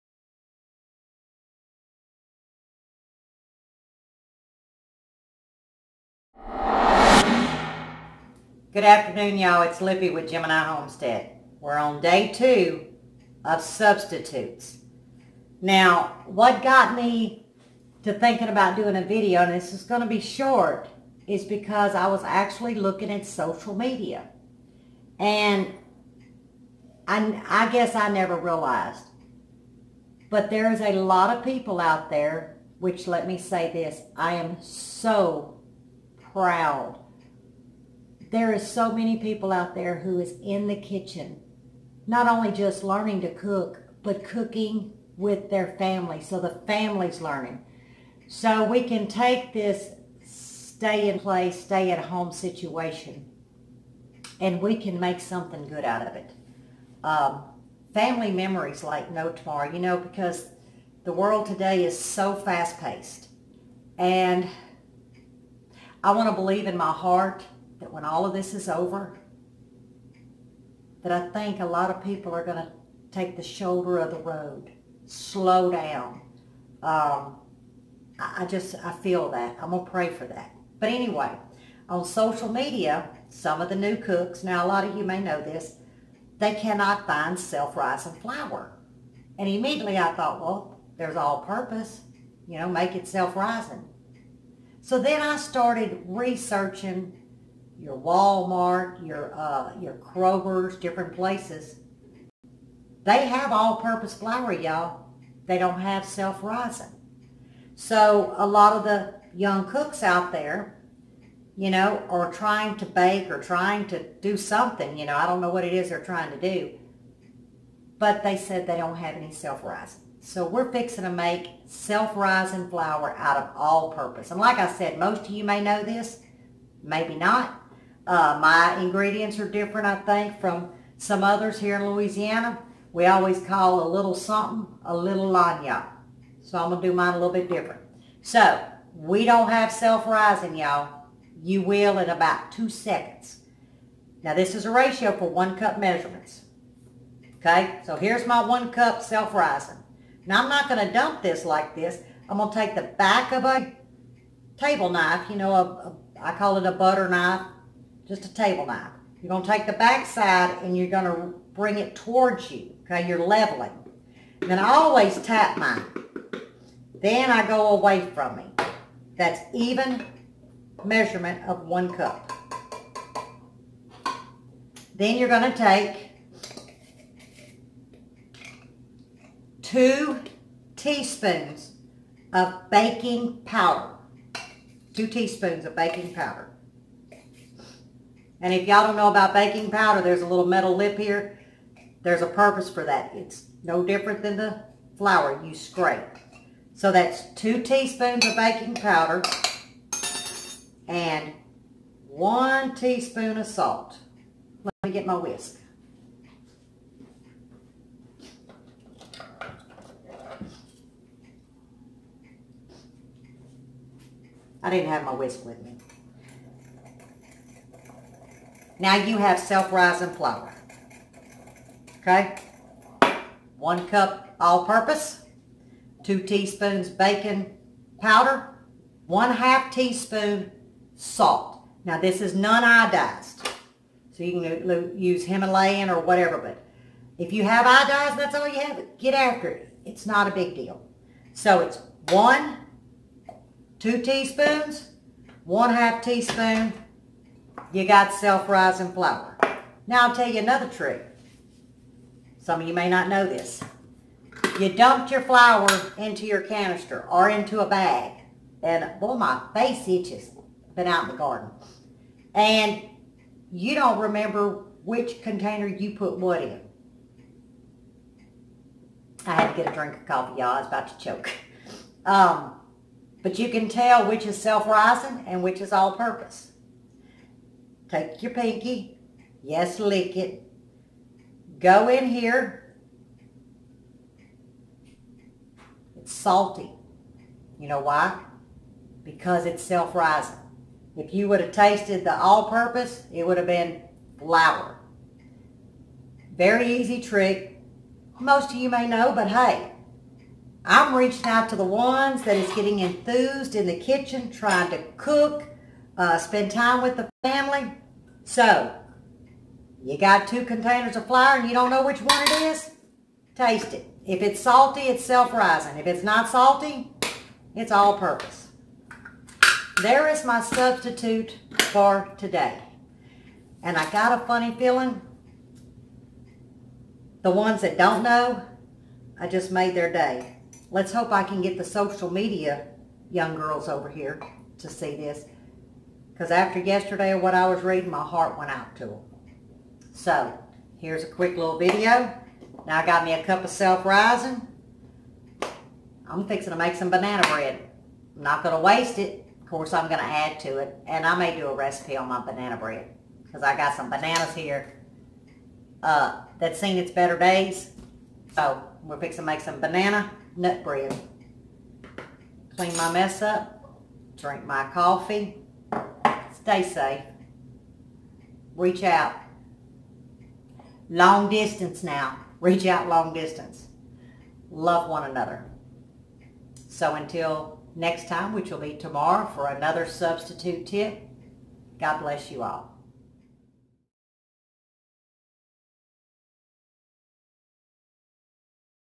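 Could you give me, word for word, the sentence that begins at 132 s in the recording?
We always call a little something a little lagniappe.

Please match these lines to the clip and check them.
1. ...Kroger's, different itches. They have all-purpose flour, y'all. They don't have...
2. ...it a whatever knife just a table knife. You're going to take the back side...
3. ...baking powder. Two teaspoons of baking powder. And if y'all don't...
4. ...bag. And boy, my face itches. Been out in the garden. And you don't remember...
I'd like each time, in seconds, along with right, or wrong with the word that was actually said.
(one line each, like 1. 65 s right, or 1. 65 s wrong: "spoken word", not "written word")
1. 99 s wrong: "places", not "itches"
2. 156 s wrong: "butter", not "whatever"
3. 182 s right
4. 257 s right.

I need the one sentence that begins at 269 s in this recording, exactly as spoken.
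I had to get a drink of coffee, y'all.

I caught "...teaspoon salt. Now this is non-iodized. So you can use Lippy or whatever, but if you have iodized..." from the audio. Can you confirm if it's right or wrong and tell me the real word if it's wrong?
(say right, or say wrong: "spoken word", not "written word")
wrong: "Himalayan", not "Lippy".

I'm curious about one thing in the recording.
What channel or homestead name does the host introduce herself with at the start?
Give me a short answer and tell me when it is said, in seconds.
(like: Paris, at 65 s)
Gemini Homestead, at 10 s.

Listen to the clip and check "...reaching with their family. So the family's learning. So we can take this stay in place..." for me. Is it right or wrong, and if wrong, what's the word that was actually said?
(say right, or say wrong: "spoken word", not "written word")
wrong: "cooking", not "reaching".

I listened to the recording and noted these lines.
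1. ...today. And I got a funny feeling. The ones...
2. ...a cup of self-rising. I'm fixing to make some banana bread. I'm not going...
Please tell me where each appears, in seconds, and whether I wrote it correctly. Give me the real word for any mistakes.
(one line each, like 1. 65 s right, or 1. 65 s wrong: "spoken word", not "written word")
1. 322 s right
2. 343 s right.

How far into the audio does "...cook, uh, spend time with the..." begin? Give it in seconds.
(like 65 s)
304 s.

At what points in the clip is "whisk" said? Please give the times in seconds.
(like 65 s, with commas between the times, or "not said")
205 s, 215 s.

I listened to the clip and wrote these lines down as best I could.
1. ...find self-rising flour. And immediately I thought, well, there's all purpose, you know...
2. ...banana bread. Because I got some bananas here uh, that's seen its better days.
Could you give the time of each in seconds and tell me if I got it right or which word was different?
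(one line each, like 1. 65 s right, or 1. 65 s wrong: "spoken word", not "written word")
1. 87 s right
2. 352 s right.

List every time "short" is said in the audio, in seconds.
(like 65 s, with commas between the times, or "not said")
20 s.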